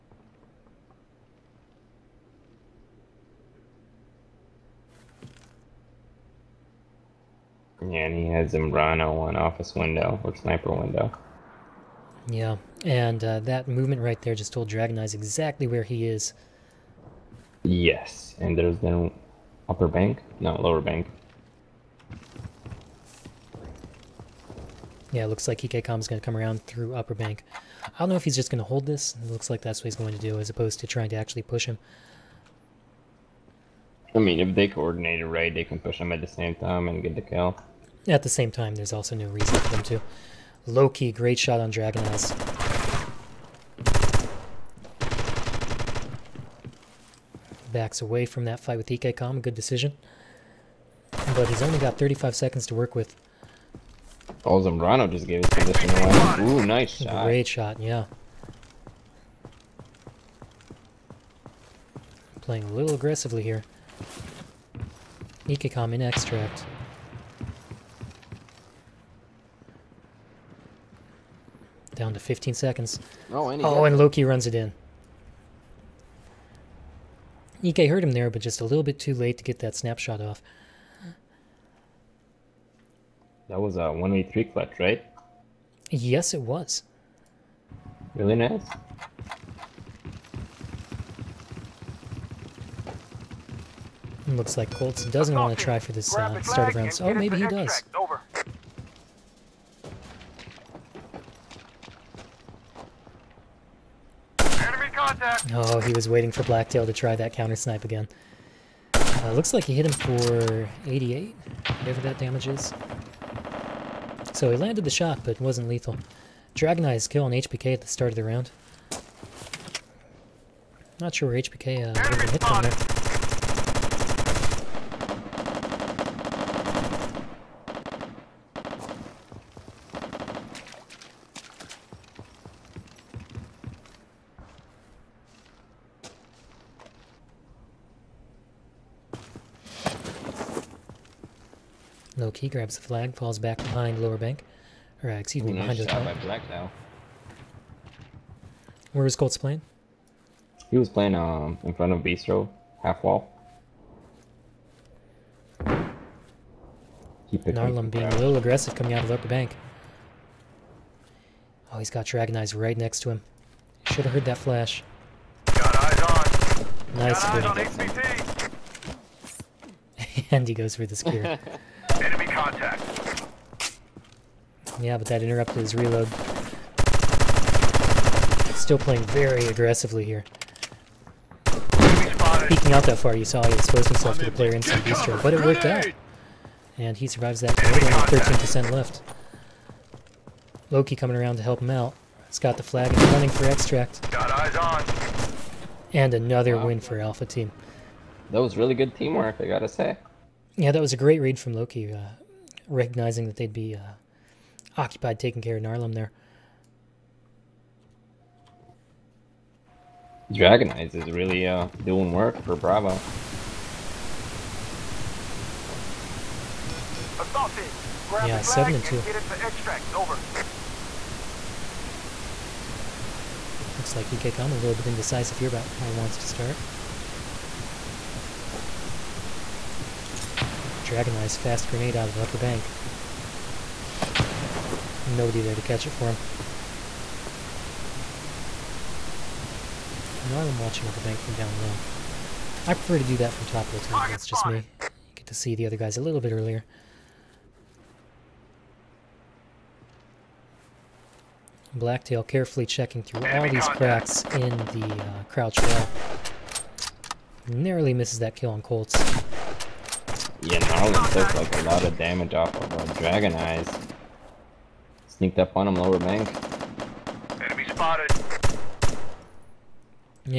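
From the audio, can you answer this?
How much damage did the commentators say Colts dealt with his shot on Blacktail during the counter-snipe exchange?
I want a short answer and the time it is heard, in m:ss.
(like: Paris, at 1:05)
88, at 1:50.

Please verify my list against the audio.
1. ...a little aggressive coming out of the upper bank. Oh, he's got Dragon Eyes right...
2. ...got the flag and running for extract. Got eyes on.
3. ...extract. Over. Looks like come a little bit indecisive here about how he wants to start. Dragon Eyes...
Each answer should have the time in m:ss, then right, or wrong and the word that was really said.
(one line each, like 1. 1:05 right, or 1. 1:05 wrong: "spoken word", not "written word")
1. 2:38 right
2. 3:12 right
3. 3:39 right.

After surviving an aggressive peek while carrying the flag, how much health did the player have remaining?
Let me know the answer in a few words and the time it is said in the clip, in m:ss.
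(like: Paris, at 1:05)
13%, at 3:07.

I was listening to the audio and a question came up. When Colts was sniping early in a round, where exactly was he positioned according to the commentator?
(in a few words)
In front of Bistro, half wall.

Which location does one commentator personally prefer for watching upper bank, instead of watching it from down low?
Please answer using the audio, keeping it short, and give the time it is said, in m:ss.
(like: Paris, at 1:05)
Top hotel, at 4:03.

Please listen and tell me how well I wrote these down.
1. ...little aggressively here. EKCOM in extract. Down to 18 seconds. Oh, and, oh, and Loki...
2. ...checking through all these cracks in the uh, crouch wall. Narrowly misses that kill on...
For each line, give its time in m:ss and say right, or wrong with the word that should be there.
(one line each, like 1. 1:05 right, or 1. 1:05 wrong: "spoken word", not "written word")
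1. 1:02 wrong: "15", not "18"
2. 4:12 right.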